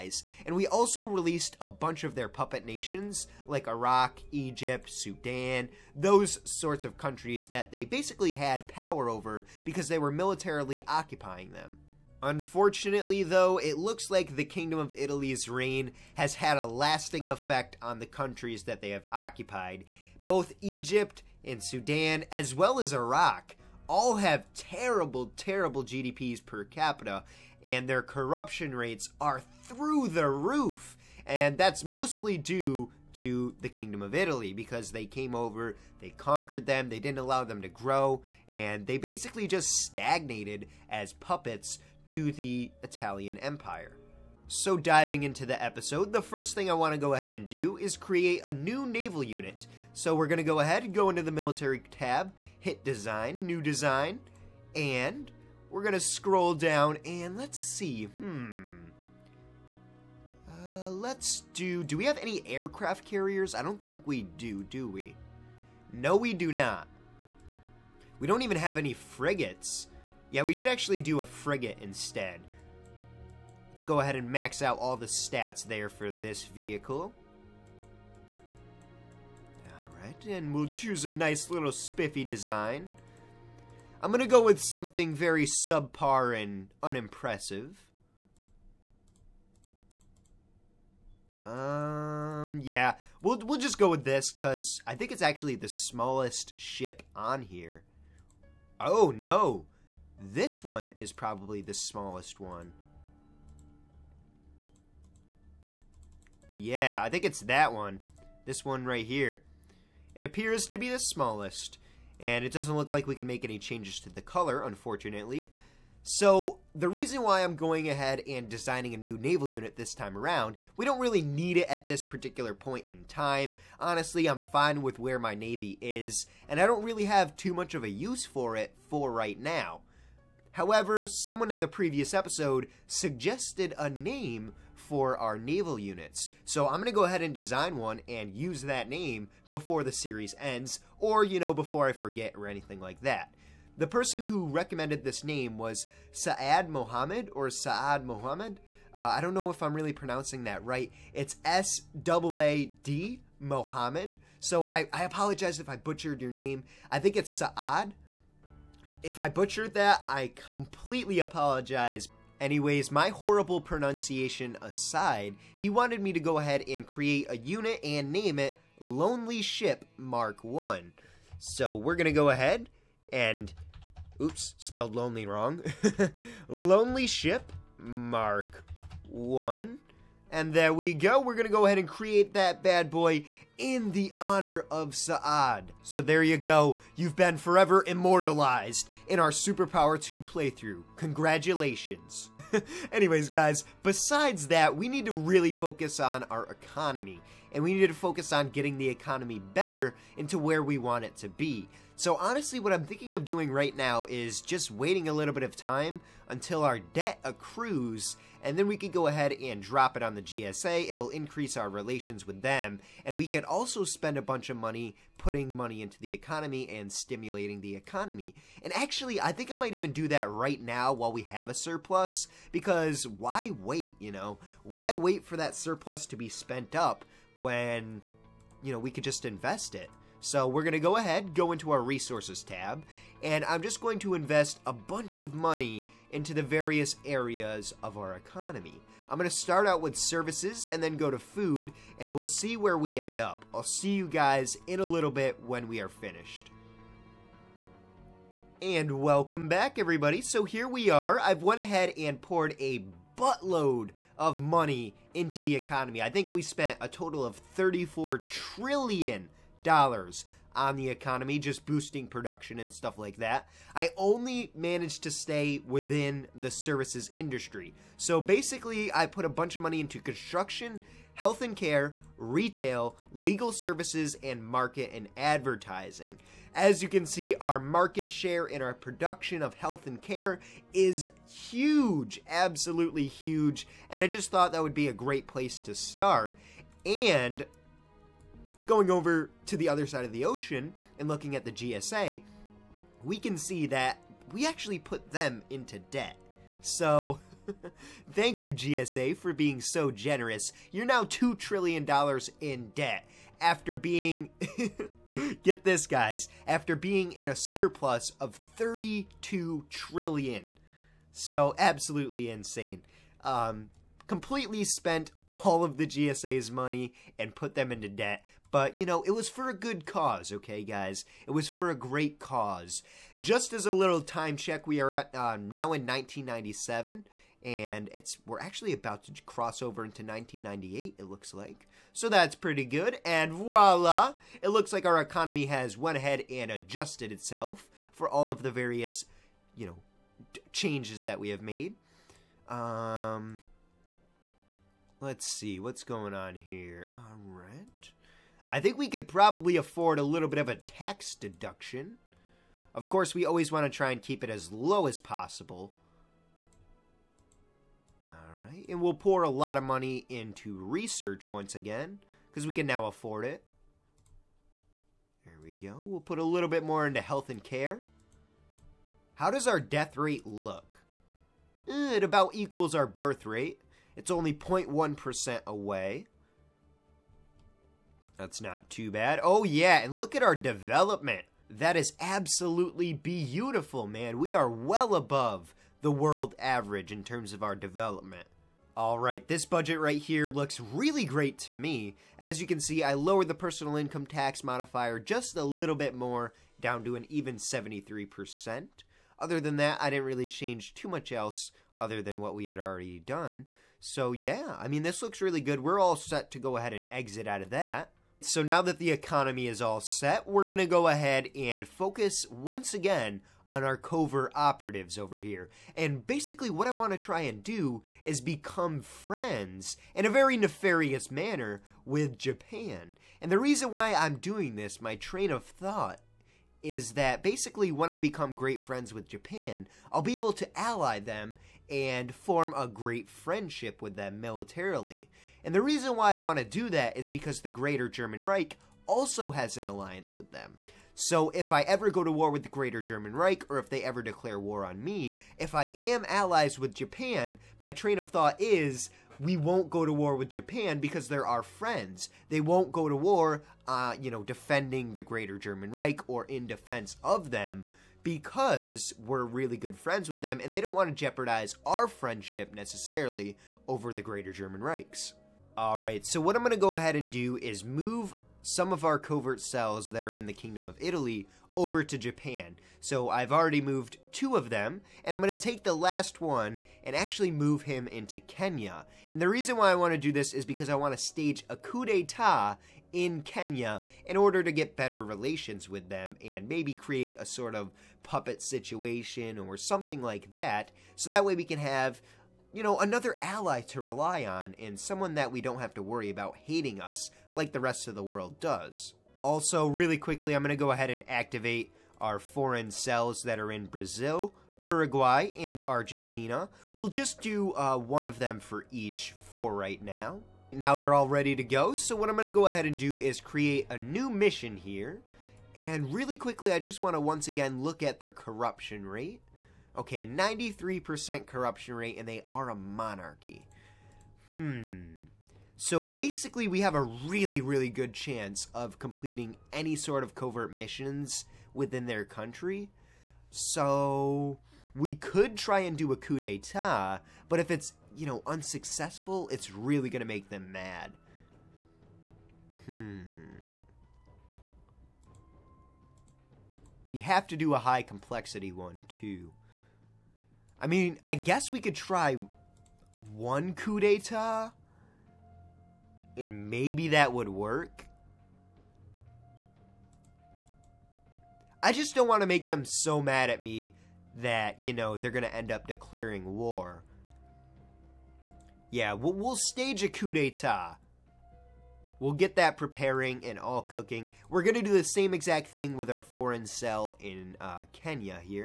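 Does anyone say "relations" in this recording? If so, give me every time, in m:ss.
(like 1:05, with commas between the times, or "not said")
3:31, 8:05.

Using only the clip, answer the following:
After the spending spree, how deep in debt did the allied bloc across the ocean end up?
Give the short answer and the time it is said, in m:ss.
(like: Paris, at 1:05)
$2 trillion, at 5:01.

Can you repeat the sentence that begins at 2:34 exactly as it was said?
So I, I apologize if I butchered your name.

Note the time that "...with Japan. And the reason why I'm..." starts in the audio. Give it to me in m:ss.
7:01.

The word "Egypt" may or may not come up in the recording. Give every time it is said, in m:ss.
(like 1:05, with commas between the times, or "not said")
0:04, 0:20.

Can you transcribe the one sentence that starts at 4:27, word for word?
So basically, I put a bunch of money into construction, health and care, retail, legal services, and market and advertising.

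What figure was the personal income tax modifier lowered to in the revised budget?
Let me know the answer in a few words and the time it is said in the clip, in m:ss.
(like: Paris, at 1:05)
73%, at 6:37.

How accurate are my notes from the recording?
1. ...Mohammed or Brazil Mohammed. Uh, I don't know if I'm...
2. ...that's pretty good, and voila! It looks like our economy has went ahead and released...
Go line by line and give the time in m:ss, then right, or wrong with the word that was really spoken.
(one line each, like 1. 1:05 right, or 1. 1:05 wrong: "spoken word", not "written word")
1. 2:26 wrong: "Saad", not "Brazil"
2. 5:32 wrong: "adjusted", not "released".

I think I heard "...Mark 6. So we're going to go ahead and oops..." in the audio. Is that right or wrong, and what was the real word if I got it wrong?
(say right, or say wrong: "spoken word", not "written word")
wrong: "1", not "6".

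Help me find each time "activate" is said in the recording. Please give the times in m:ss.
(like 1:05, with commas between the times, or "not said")
8:21.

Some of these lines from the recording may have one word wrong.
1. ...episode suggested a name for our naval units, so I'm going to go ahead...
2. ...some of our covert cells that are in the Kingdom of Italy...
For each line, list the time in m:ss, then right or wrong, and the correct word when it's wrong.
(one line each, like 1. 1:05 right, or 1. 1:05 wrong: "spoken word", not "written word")
1. 2:12 right
2. 7:48 right.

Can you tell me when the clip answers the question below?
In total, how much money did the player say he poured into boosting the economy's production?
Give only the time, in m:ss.
4:17.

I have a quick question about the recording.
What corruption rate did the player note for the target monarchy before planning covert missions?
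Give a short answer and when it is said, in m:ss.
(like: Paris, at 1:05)
93%, at 8:40.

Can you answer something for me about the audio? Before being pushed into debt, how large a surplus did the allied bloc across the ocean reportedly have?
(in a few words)
32 trillion.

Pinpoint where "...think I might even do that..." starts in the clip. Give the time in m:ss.
3:39.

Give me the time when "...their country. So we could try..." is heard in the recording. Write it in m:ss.
8:51.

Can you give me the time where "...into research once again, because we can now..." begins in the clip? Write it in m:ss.
6:00.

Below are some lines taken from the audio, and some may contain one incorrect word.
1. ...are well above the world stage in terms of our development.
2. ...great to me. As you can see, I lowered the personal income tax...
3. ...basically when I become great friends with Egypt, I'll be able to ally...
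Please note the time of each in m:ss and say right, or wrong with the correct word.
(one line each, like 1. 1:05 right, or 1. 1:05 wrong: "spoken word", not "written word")
1. 6:24 wrong: "average", not "stage"
2. 6:31 right
3. 7:07 wrong: "Japan", not "Egypt".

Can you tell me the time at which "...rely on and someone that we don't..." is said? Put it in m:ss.
8:13.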